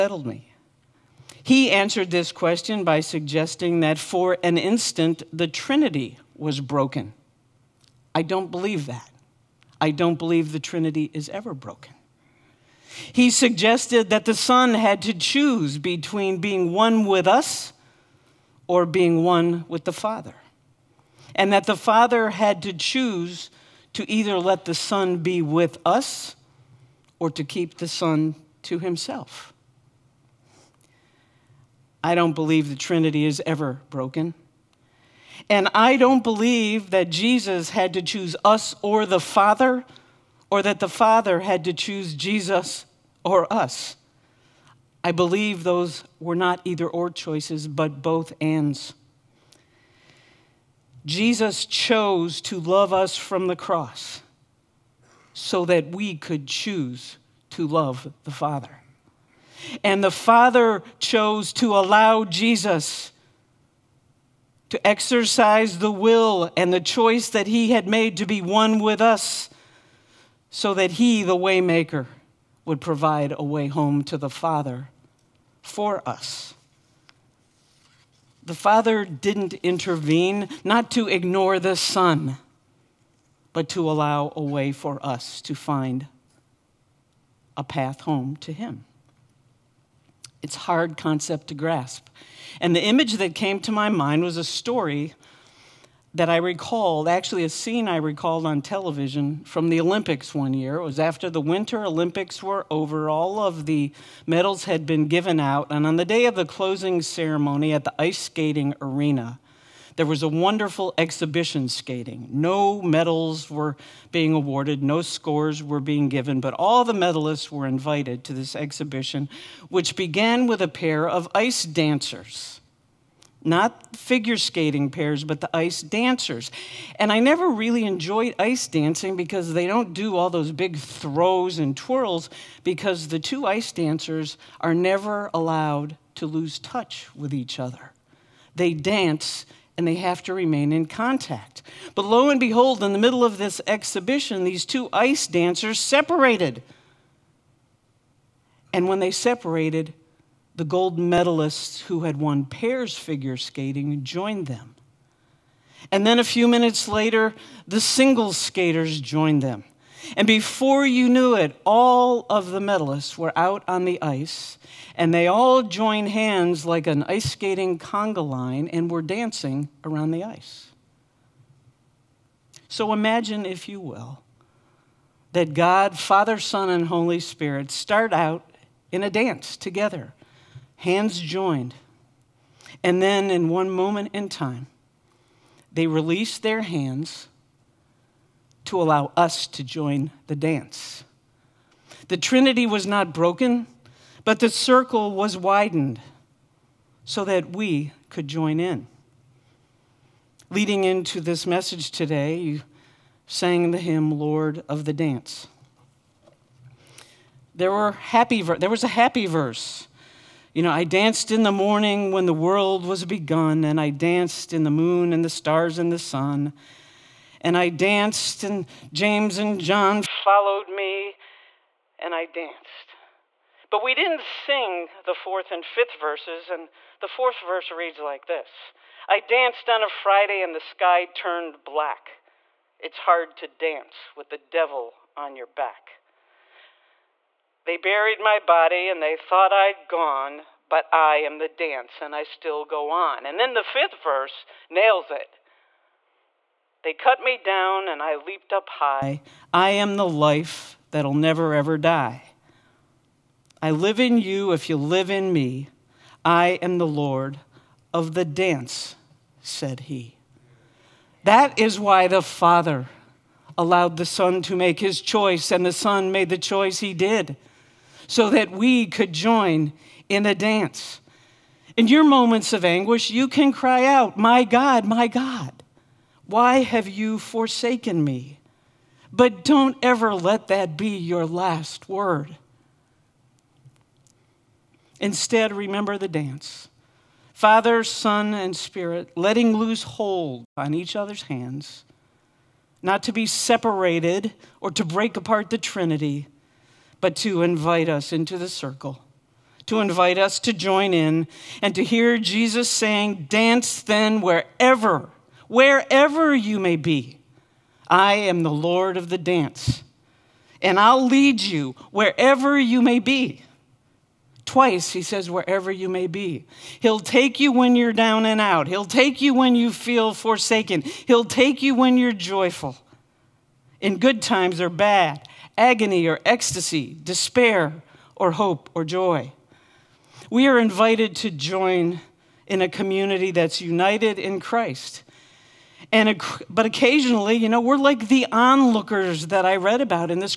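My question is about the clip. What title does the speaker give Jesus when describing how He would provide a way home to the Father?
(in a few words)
Waymaker.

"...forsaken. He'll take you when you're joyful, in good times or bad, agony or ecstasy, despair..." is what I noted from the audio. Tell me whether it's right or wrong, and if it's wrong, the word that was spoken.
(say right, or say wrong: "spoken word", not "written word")
right.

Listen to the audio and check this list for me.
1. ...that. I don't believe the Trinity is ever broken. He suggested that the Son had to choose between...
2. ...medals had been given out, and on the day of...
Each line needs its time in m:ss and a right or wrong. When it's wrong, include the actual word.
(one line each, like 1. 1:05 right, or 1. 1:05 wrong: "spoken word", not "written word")
1. 0:08 right
2. 1:44 right.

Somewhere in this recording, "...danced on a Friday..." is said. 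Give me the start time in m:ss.
3:49.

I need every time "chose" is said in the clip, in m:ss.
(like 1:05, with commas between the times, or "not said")
0:51, 1:00.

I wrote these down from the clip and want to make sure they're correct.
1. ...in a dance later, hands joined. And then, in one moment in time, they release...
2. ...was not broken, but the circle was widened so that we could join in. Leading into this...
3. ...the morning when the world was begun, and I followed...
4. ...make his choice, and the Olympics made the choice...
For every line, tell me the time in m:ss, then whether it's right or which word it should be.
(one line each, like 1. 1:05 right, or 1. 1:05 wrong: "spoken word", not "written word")
1. 2:58 wrong: "together", not "later"
2. 3:12 right
3. 3:31 wrong: "danced", not "followed"
4. 4:24 wrong: "Son", not "Olympics".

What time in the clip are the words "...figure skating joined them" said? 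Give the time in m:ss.
2:32.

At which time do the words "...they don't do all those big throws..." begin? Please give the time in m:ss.
2:09.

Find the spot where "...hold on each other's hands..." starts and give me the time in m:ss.
4:49.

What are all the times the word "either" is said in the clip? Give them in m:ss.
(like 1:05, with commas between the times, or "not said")
0:24, 0:46.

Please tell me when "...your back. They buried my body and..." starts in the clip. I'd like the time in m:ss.
3:55.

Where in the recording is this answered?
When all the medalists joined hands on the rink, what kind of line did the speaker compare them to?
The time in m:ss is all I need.
2:47.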